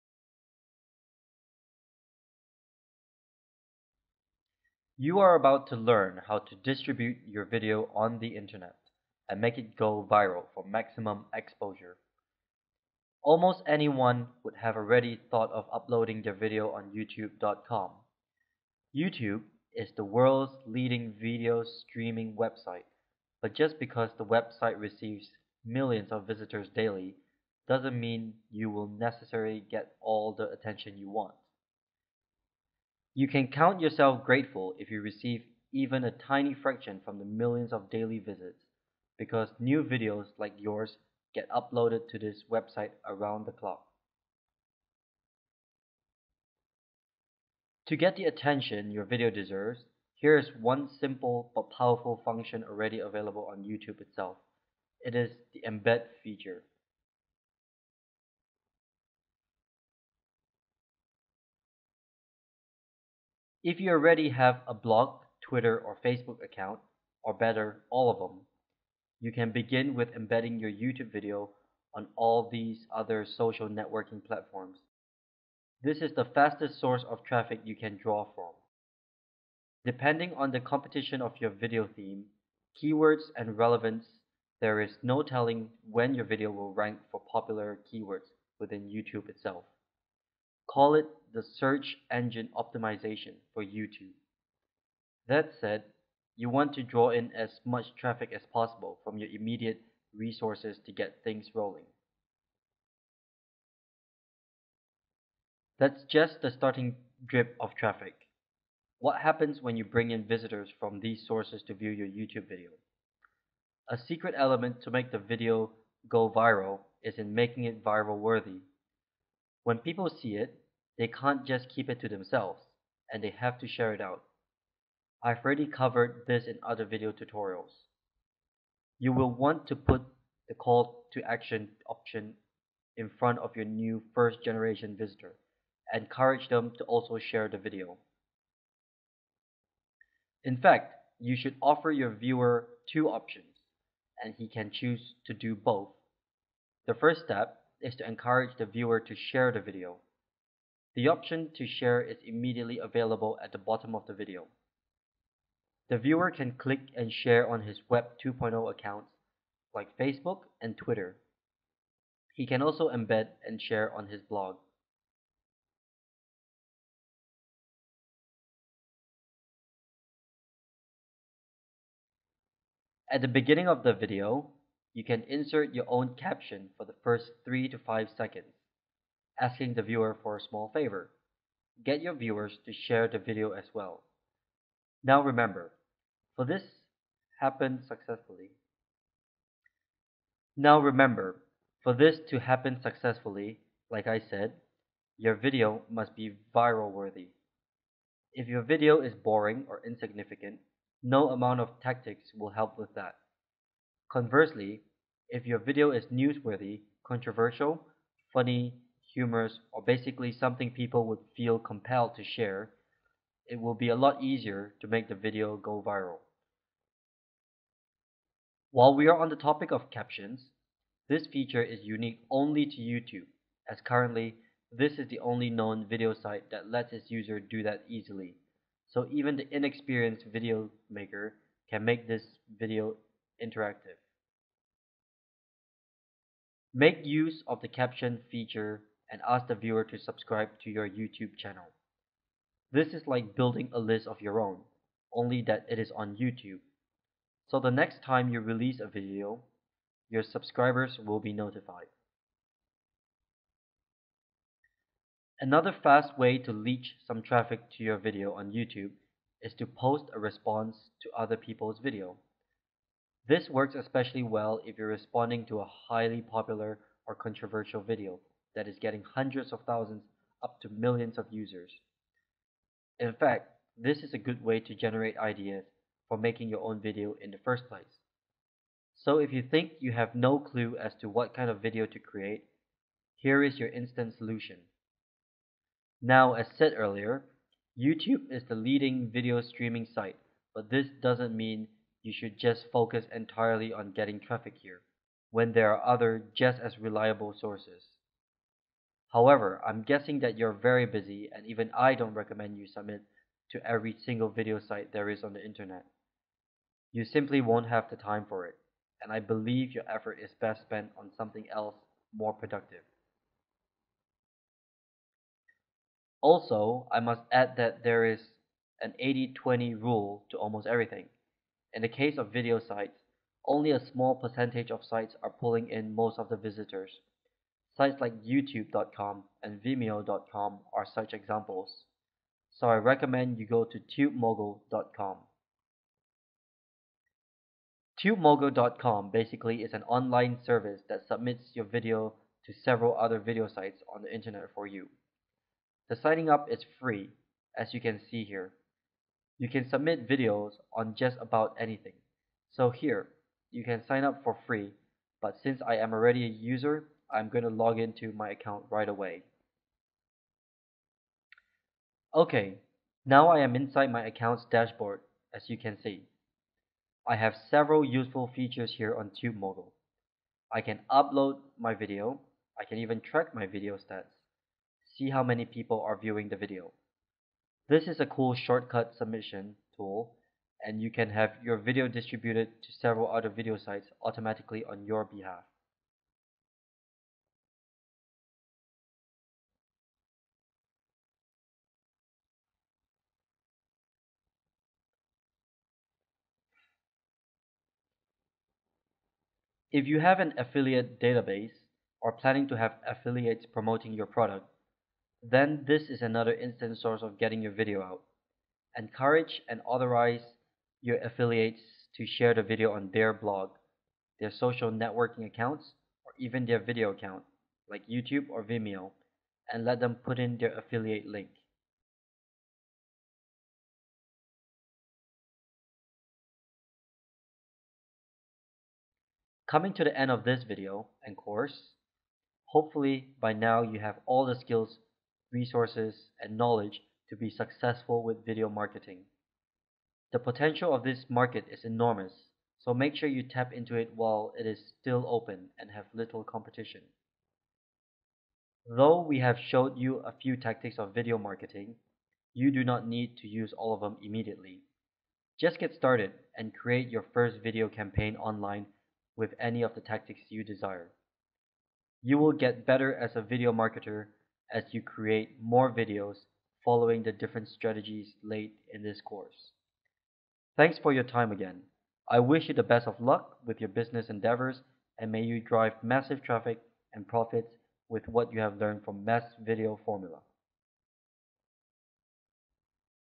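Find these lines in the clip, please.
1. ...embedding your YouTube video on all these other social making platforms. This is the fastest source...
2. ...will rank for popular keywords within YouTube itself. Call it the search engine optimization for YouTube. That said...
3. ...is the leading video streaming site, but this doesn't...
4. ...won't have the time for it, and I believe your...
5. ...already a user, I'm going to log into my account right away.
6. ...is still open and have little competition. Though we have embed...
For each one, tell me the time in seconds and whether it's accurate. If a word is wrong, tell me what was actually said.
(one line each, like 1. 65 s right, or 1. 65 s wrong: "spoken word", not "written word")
1. 70 s wrong: "networking", not "making"
2. 86 s right
3. 288 s right
4. 307 s right
5. 355 s right
6. 444 s wrong: "showed", not "embed".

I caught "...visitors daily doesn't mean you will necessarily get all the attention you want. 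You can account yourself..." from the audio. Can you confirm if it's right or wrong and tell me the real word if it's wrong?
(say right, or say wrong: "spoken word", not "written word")
wrong: "count", not "account".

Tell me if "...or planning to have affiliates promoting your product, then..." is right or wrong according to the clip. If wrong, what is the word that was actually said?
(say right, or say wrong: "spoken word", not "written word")
right.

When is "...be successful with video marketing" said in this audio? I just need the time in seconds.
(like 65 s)
437 s.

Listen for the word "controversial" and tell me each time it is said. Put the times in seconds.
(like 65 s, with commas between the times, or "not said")
207 s, 267 s.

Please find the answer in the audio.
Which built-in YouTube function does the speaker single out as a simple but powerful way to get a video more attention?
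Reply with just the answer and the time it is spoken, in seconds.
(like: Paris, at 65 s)
embed feature, at 55 s.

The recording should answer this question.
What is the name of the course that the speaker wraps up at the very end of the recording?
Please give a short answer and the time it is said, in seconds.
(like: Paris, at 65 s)
Mass Video Formula, at 479 s.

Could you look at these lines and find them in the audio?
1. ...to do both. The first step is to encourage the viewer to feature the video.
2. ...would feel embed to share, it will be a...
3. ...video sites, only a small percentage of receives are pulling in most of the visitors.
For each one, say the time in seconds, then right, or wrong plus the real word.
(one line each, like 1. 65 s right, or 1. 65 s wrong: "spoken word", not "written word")
1. 145 s wrong: "share", not "feature"
2. 211 s wrong: "compelled", not "embed"
3. 322 s wrong: "sites", not "receives".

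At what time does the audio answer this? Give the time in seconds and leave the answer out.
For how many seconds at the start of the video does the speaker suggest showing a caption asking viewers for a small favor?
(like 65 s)
177 s.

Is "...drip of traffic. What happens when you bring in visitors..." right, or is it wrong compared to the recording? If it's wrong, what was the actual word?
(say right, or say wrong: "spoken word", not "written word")
right.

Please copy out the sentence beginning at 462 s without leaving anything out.
You will get better as a video marketer as you create more videos following the different strategies laid in this course.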